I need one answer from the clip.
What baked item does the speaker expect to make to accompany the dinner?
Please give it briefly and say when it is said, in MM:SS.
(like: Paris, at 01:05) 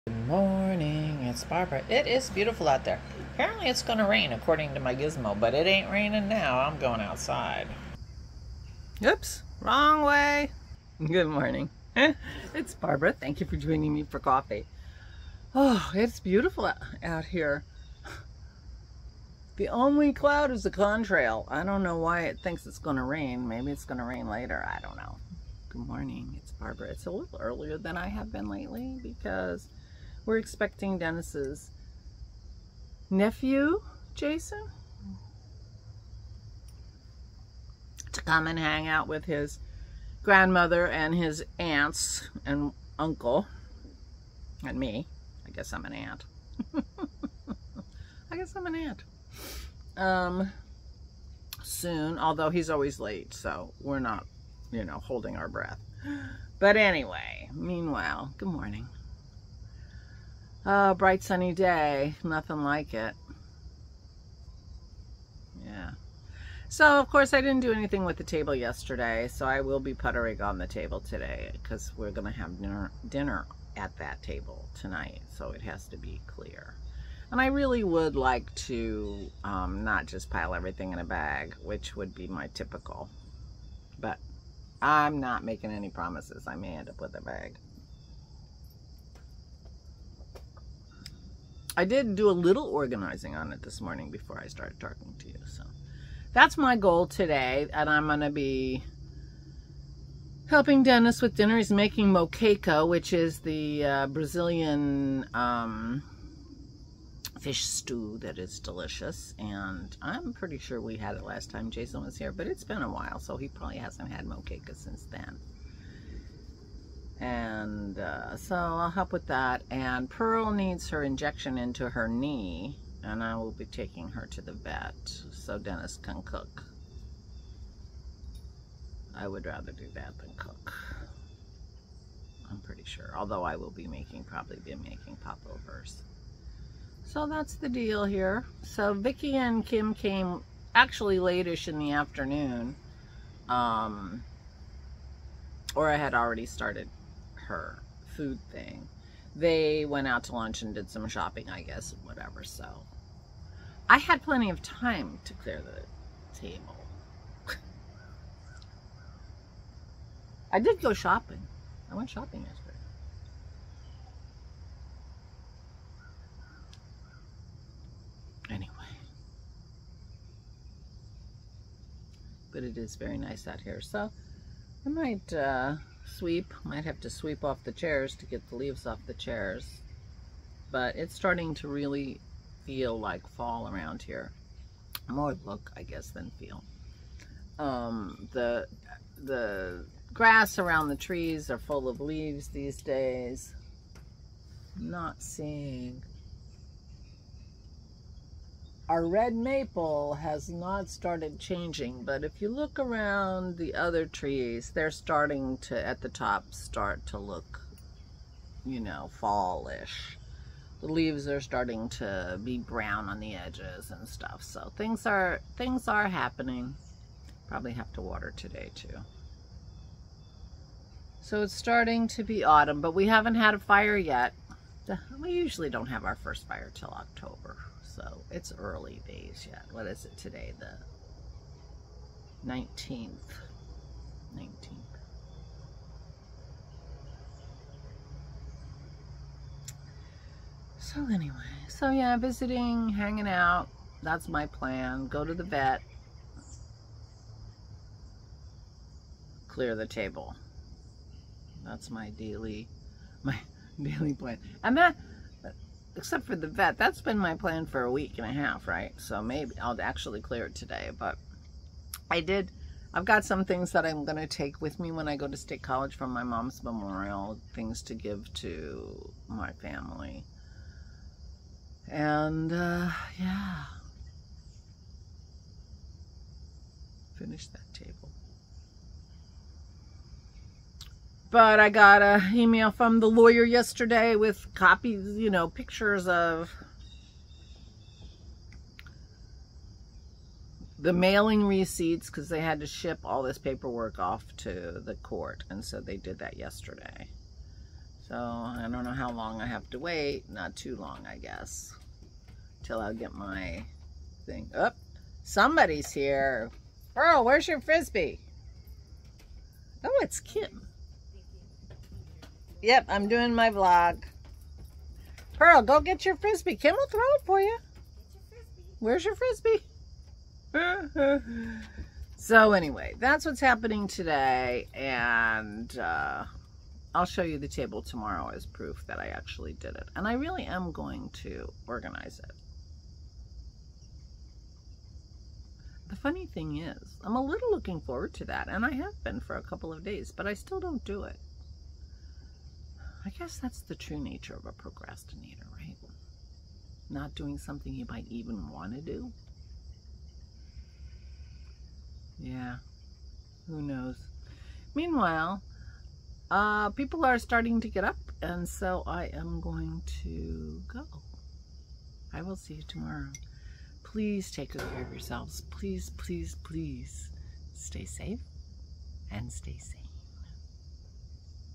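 popovers, at 02:15.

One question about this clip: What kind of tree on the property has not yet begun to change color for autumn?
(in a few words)
red maple.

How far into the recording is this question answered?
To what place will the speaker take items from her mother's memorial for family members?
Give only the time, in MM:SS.
04:25.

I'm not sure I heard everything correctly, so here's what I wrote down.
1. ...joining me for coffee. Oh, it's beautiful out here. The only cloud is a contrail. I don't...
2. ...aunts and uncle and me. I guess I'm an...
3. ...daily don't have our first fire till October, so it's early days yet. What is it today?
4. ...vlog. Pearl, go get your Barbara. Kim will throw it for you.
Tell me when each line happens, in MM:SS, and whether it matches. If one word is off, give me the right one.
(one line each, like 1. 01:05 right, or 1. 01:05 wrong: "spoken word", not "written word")
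1. 00:13 right
2. 00:41 right
3. 03:45 wrong: "usually", not "daily"
4. 05:13 wrong: "Frisbee", not "Barbara".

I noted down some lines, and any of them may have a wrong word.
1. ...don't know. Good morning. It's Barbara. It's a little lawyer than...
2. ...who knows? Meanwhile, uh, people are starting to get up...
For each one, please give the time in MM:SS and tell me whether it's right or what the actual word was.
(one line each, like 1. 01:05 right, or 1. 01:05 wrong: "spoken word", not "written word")
1. 00:24 wrong: "earlier", not "lawyer"
2. 05:53 right.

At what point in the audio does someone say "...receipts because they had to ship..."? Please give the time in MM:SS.
04:51.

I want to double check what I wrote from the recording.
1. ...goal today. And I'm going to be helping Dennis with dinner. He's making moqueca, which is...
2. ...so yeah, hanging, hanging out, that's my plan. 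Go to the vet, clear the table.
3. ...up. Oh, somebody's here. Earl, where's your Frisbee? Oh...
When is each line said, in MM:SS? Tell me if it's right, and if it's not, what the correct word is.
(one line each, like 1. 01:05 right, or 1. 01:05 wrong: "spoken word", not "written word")
1. 01:36 right
2. 04:01 wrong: "visiting", not "hanging"
3. 05:04 right.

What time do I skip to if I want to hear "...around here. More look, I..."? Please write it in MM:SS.
03:03.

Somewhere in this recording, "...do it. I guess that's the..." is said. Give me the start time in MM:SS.
05:40.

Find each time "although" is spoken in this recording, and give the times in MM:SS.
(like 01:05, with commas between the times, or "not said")
00:52, 02:13.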